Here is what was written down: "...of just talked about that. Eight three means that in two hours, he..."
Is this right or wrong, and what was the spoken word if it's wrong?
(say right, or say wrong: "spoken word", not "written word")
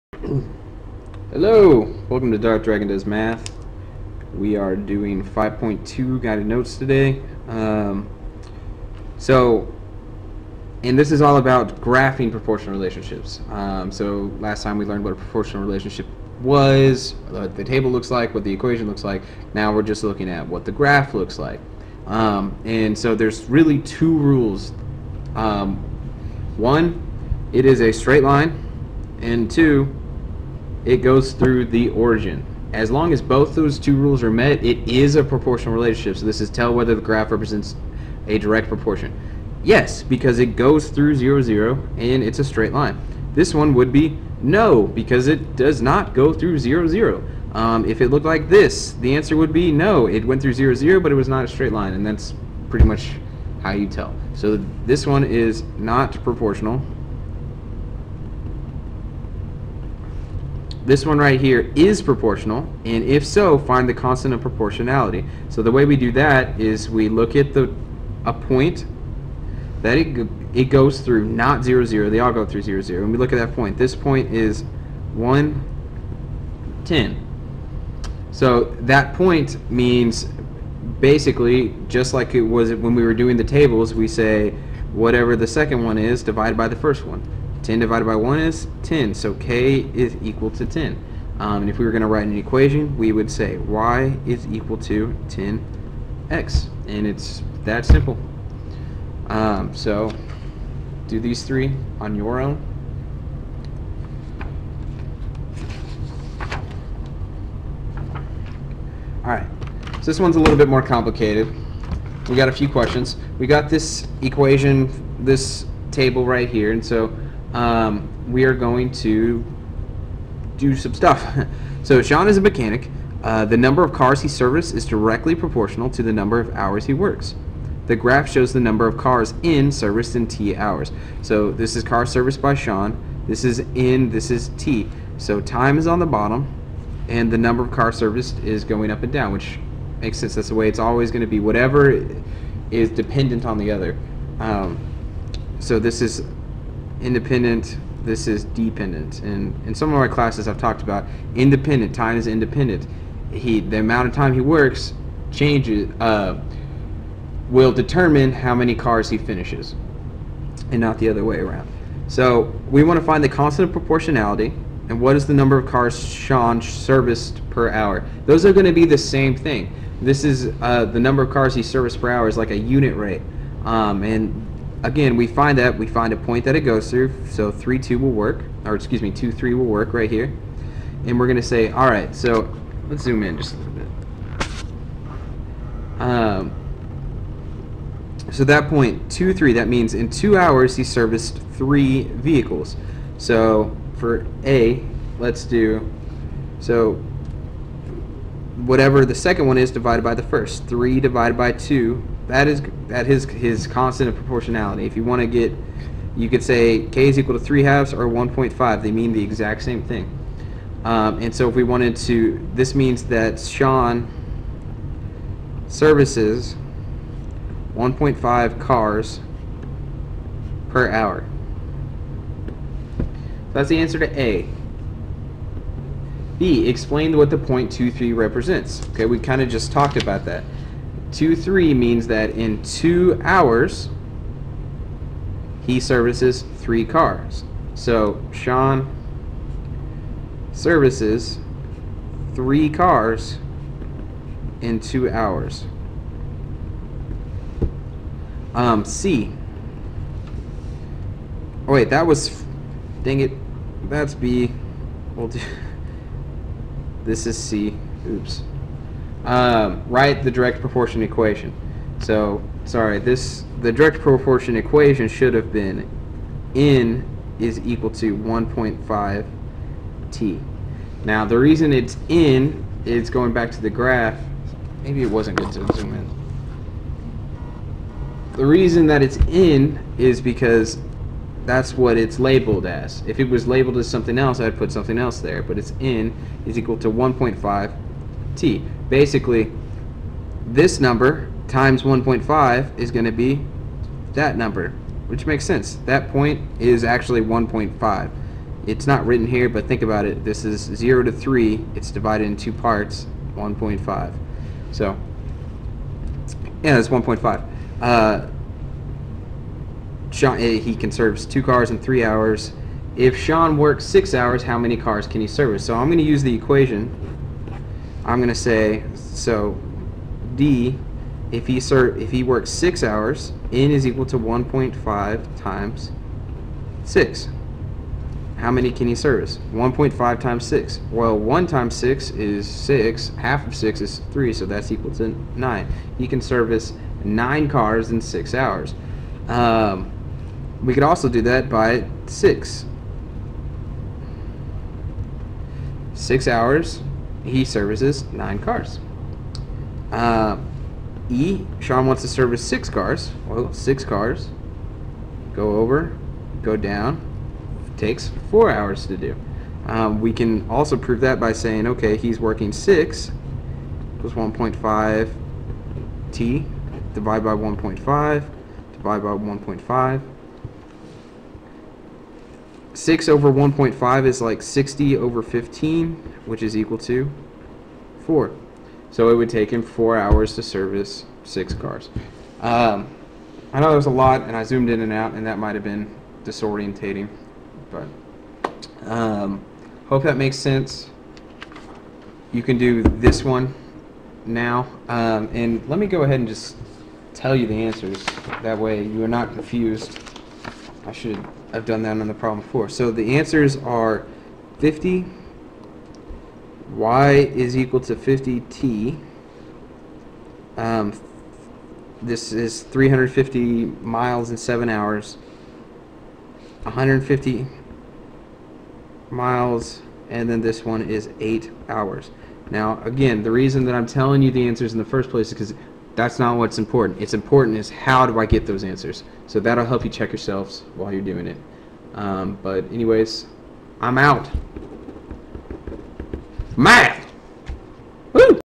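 wrong: "Two", not "Eight".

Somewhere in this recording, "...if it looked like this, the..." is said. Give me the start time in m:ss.
0:47.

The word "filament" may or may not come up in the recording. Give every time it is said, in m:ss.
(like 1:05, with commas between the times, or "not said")
not said.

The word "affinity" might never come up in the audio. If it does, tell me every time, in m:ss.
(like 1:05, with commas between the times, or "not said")
not said.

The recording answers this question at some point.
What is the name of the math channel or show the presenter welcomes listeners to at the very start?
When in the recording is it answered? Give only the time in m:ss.
0:02.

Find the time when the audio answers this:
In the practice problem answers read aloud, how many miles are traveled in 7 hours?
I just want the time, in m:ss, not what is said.
6:52.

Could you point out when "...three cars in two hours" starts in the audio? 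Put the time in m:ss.
4:02.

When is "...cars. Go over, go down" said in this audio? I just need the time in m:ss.
5:53.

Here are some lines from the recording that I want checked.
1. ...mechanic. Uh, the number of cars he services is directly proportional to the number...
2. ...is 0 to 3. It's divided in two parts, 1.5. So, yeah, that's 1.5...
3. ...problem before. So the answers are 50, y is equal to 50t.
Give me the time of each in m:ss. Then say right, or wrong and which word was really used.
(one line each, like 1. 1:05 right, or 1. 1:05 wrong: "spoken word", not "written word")
1. 2:02 right
2. 5:00 right
3. 6:42 right.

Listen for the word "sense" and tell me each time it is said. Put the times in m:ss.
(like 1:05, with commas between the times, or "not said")
2:20, 4:55, 6:30.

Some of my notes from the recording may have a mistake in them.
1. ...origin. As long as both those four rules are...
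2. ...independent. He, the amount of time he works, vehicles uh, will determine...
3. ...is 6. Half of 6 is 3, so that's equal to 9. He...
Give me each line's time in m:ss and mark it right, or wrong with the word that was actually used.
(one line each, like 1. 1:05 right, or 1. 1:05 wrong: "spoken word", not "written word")
1. 0:31 wrong: "two", not "four"
2. 2:32 wrong: "changes", not "vehicles"
3. 5:32 right.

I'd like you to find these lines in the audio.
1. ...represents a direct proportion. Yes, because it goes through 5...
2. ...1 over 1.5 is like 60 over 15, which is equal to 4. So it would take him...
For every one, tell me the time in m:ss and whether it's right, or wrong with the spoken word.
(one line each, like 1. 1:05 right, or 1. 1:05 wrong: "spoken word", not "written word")
1. 0:37 wrong: "0", not "5"
2. 6:12 wrong: "6", not "1".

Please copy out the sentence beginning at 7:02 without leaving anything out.
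Now again, the reason that I'm telling you the answers in the first place is because that's not what's important.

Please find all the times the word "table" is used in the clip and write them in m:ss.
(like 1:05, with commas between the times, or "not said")
0:17, 1:23, 1:55.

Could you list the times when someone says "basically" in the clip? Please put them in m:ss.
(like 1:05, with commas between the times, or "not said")
1:20, 4:48.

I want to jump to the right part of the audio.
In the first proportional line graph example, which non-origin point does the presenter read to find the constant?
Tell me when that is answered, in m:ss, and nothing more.
1:15.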